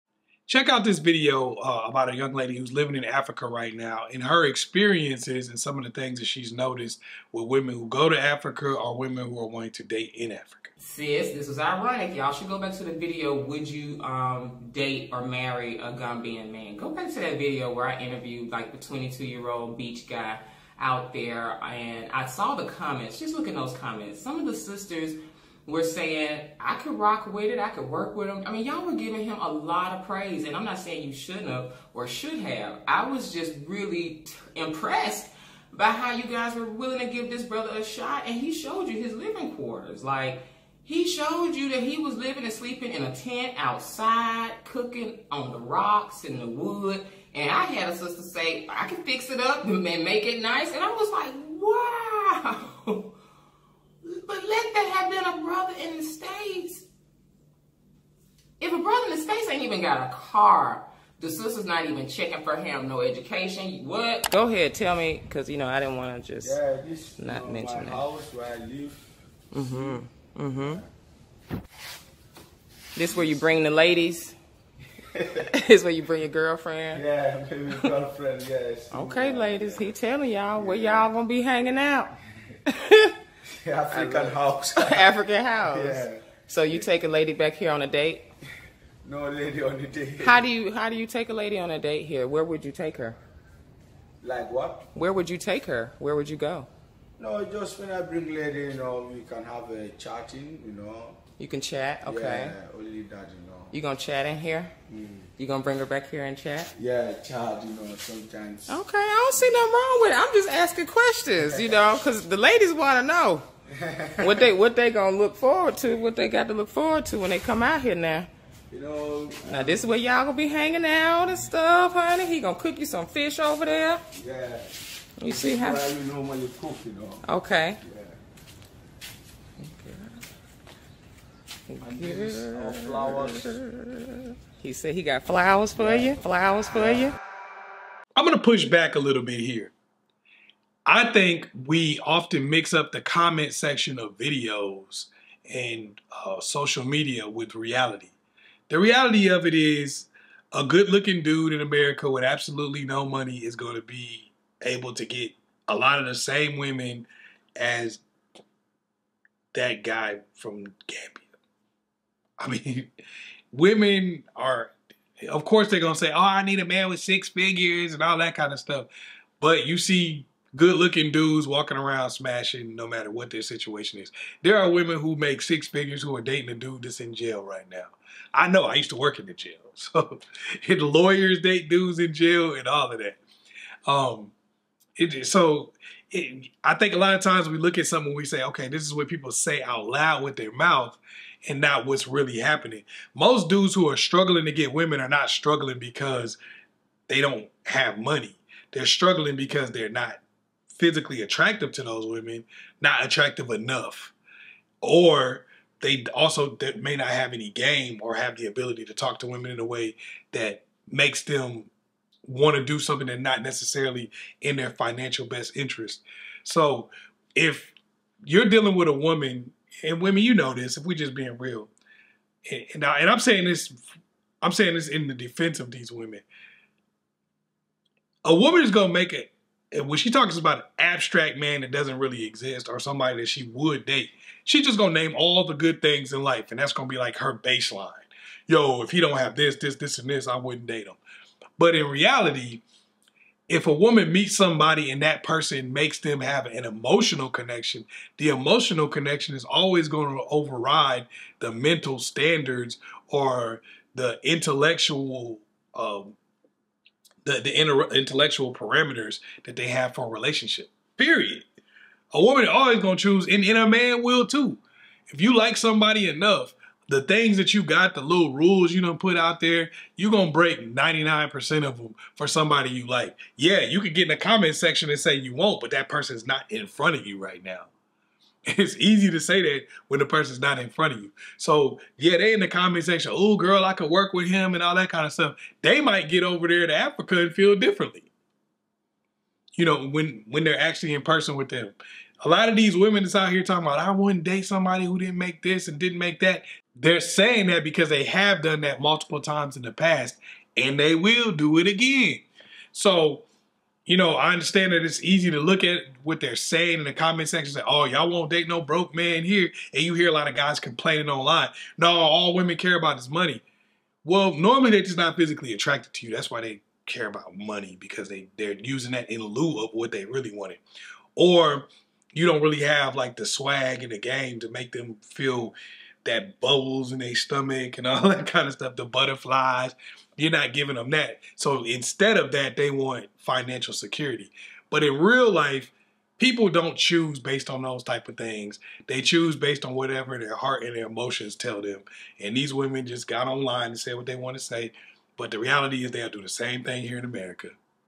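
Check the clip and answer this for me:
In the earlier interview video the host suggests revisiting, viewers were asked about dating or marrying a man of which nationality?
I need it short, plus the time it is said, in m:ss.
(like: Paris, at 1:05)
Gambian, at 0:15.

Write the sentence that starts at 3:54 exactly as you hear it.
She's just gonna name all the good things in life, and that's gonna be like her baseline.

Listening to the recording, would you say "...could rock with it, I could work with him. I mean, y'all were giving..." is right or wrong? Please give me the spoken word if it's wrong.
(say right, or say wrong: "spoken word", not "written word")
right.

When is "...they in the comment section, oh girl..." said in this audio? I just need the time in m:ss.
4:42.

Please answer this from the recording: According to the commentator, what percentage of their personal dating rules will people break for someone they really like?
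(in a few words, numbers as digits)
99%.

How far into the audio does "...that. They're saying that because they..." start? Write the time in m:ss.
4:56.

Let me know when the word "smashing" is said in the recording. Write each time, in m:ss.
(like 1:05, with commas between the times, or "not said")
2:52.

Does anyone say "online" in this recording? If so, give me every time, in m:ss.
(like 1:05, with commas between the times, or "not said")
5:11, 5:43.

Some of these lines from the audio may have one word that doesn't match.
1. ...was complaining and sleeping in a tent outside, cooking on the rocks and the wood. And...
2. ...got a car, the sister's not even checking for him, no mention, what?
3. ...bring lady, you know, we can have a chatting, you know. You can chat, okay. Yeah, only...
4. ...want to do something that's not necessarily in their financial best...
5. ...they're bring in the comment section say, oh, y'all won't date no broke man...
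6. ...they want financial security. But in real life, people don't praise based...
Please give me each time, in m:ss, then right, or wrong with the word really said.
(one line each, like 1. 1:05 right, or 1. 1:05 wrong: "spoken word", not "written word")
1. 0:41 wrong: "living", not "complaining"
2. 0:59 wrong: "education", not "mention"
3. 1:38 right
4. 3:32 right
5. 5:06 wrong: "saying", not "bring"
6. 5:32 wrong: "choose", not "praise".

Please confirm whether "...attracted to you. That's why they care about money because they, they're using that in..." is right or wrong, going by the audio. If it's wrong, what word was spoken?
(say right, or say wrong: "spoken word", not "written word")
right.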